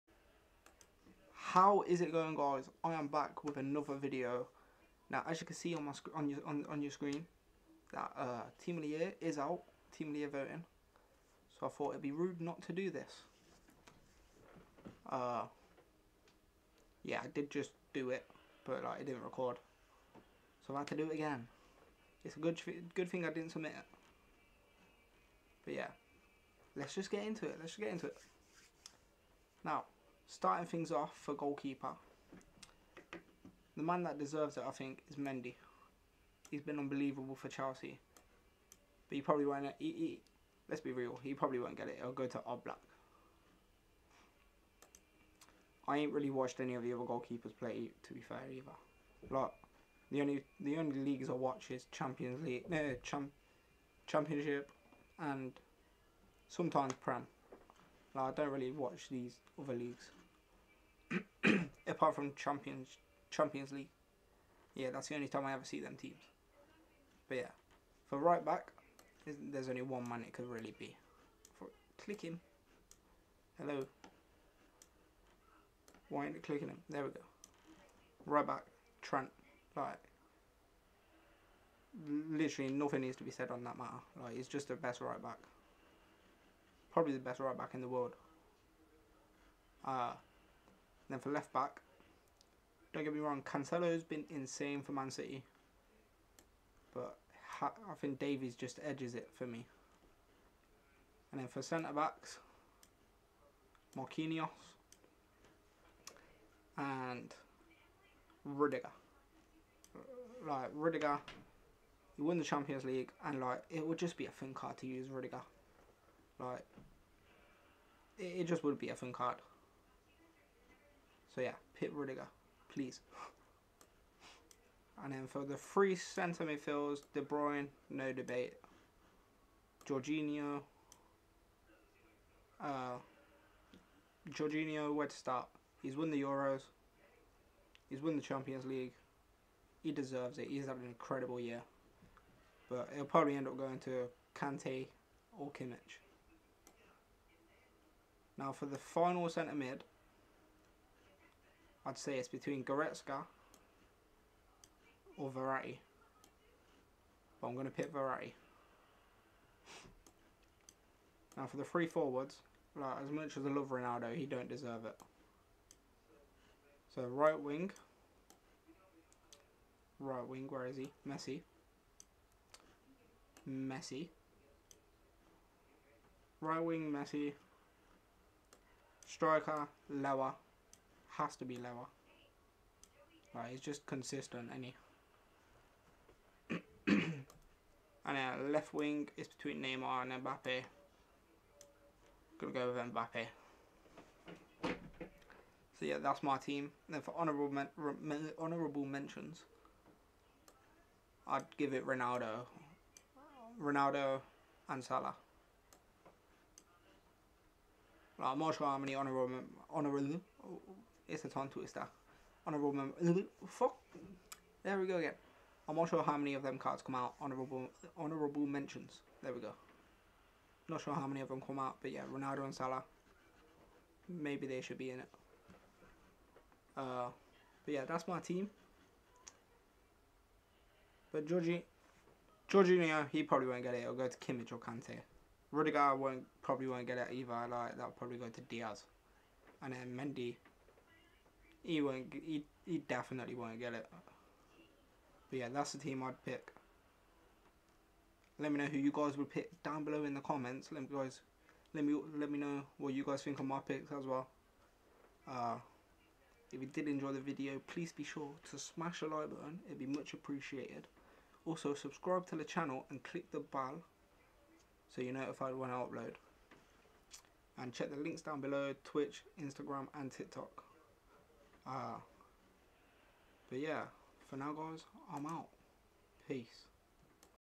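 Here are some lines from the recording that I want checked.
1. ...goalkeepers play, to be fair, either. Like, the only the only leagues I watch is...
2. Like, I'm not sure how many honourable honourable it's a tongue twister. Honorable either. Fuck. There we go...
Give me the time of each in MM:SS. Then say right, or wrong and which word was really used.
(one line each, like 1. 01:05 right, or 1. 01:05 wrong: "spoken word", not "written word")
1. 00:47 right
2. 03:28 wrong: "member", not "either".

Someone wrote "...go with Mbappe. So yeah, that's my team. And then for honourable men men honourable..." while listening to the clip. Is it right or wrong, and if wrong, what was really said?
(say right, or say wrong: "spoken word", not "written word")
right.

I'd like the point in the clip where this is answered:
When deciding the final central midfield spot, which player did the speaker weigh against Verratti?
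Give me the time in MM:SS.
02:32.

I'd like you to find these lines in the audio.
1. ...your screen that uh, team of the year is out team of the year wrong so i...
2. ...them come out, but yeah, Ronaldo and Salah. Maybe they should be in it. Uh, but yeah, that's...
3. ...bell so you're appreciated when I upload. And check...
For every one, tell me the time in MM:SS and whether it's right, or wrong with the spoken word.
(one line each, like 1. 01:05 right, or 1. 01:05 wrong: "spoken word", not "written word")
1. 00:06 wrong: "voting", not "wrong"
2. 03:41 right
3. 04:23 wrong: "notified", not "appreciated".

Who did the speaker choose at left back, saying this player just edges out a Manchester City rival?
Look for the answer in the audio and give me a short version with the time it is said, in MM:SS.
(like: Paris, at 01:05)
Davies, at 01:38.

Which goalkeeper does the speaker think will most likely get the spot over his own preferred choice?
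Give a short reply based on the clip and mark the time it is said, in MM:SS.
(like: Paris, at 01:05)
Oblak, at 00:42.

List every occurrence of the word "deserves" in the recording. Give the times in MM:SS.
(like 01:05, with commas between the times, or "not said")
00:34, 02:19, 02:44.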